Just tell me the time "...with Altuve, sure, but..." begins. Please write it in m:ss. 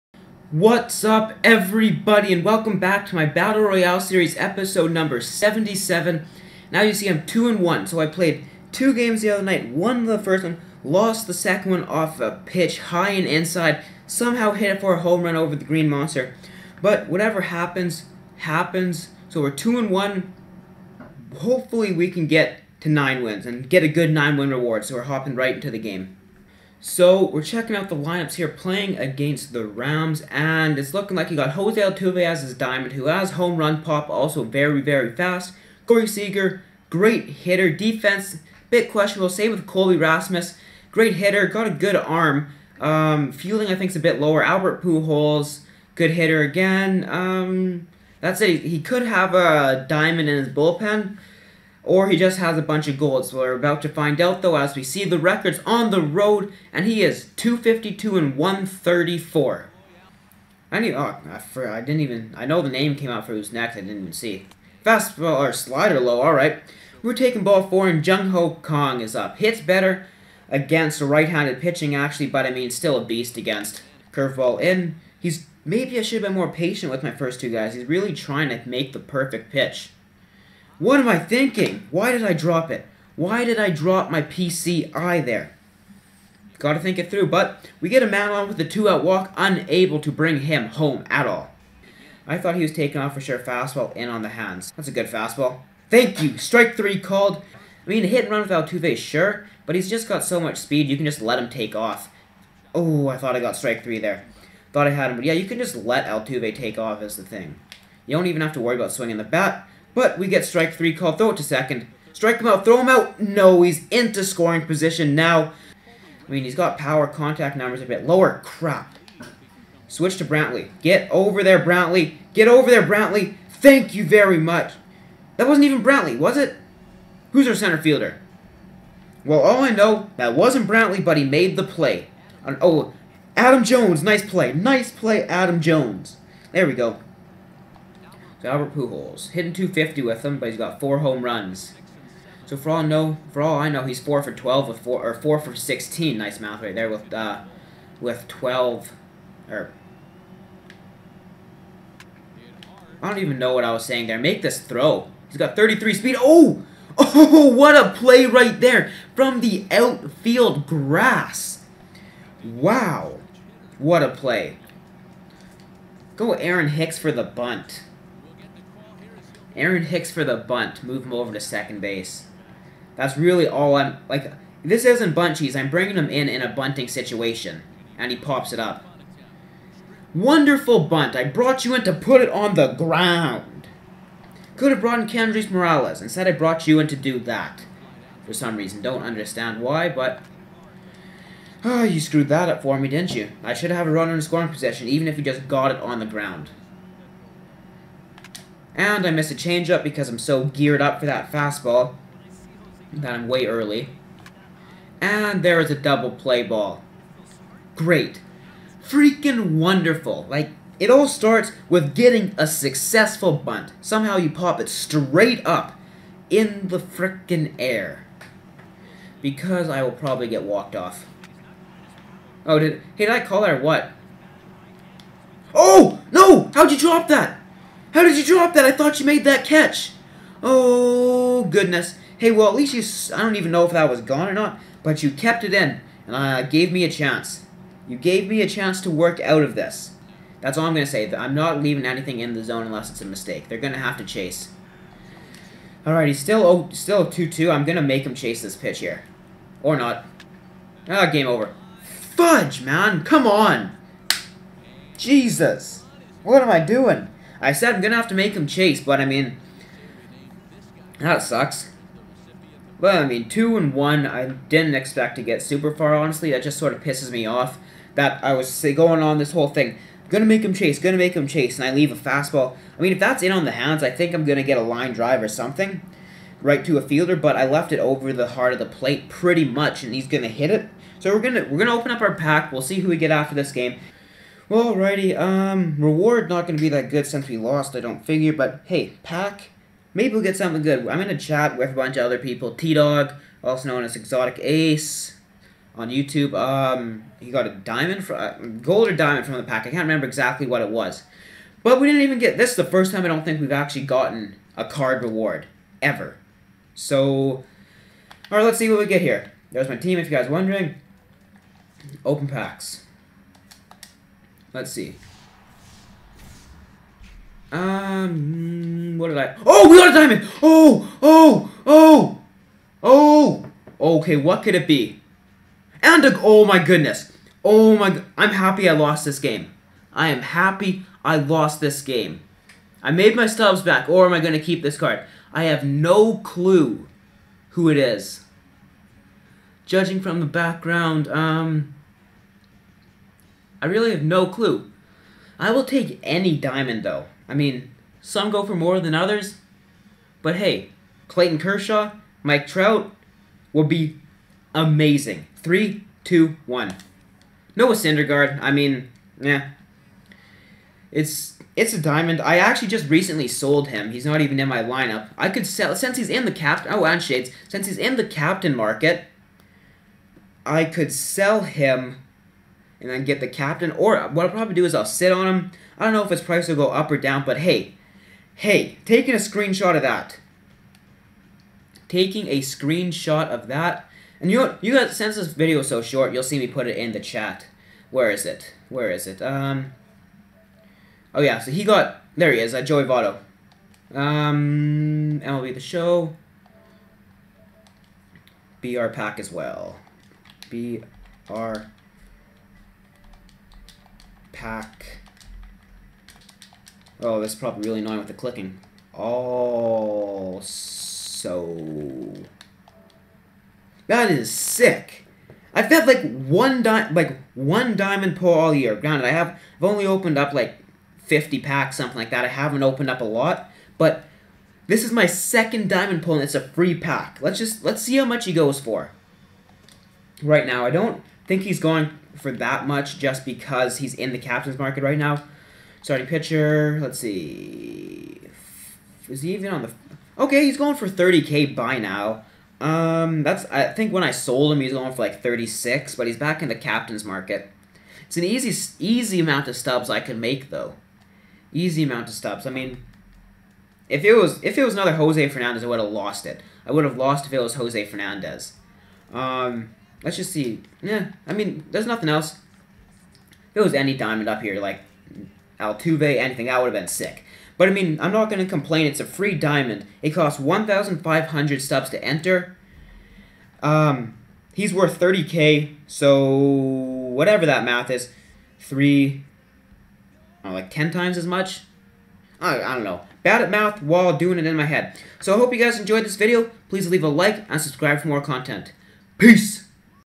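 1:38.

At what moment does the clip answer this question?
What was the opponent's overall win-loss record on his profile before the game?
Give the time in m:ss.
0:57.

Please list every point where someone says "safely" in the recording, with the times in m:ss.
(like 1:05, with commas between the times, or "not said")
not said.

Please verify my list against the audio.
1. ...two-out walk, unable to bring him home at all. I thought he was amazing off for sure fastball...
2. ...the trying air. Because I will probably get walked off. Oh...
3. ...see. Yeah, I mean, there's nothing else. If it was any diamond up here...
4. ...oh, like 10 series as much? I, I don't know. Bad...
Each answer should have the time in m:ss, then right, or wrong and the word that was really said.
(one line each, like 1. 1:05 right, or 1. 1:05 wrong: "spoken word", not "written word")
1. 1:28 wrong: "taking", not "amazing"
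2. 3:36 wrong: "freaking", not "trying"
3. 7:40 right
4. 8:00 wrong: "times", not "series".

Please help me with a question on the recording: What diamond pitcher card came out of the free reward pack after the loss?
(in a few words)
Noah Syndergaard.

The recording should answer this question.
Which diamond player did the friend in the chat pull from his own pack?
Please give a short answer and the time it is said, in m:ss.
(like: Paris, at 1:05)
Joey Votto, at 6:32.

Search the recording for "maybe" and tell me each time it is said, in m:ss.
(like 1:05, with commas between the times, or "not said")
1:15, 4:49.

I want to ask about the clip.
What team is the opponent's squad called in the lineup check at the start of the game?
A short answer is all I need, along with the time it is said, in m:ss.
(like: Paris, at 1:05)
Rams, at 0:29.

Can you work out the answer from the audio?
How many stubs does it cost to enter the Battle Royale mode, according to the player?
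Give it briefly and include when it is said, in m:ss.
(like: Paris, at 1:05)
1,500, at 7:50.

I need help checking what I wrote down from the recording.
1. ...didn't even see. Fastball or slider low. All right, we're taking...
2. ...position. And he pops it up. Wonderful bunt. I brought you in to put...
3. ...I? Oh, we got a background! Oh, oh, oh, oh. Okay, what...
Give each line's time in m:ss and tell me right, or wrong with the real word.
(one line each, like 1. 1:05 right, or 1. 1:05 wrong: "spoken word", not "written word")
1. 1:03 right
2. 2:56 wrong: "situation", not "position"
3. 5:19 wrong: "diamond", not "background".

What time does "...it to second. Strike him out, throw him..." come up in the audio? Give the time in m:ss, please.
1:51.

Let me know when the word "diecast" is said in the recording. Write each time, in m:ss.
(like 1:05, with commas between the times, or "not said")
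not said.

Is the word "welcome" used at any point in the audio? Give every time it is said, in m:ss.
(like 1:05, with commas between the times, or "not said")
0:02.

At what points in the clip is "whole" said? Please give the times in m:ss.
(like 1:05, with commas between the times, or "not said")
4:29.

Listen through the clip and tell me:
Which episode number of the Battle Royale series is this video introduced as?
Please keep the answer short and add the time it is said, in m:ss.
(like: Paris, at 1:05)
77, at 0:04.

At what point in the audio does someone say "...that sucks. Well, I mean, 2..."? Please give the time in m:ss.
4:20.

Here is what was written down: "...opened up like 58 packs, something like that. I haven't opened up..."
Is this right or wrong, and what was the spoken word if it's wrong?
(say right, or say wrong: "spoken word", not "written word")
wrong: "50", not "58".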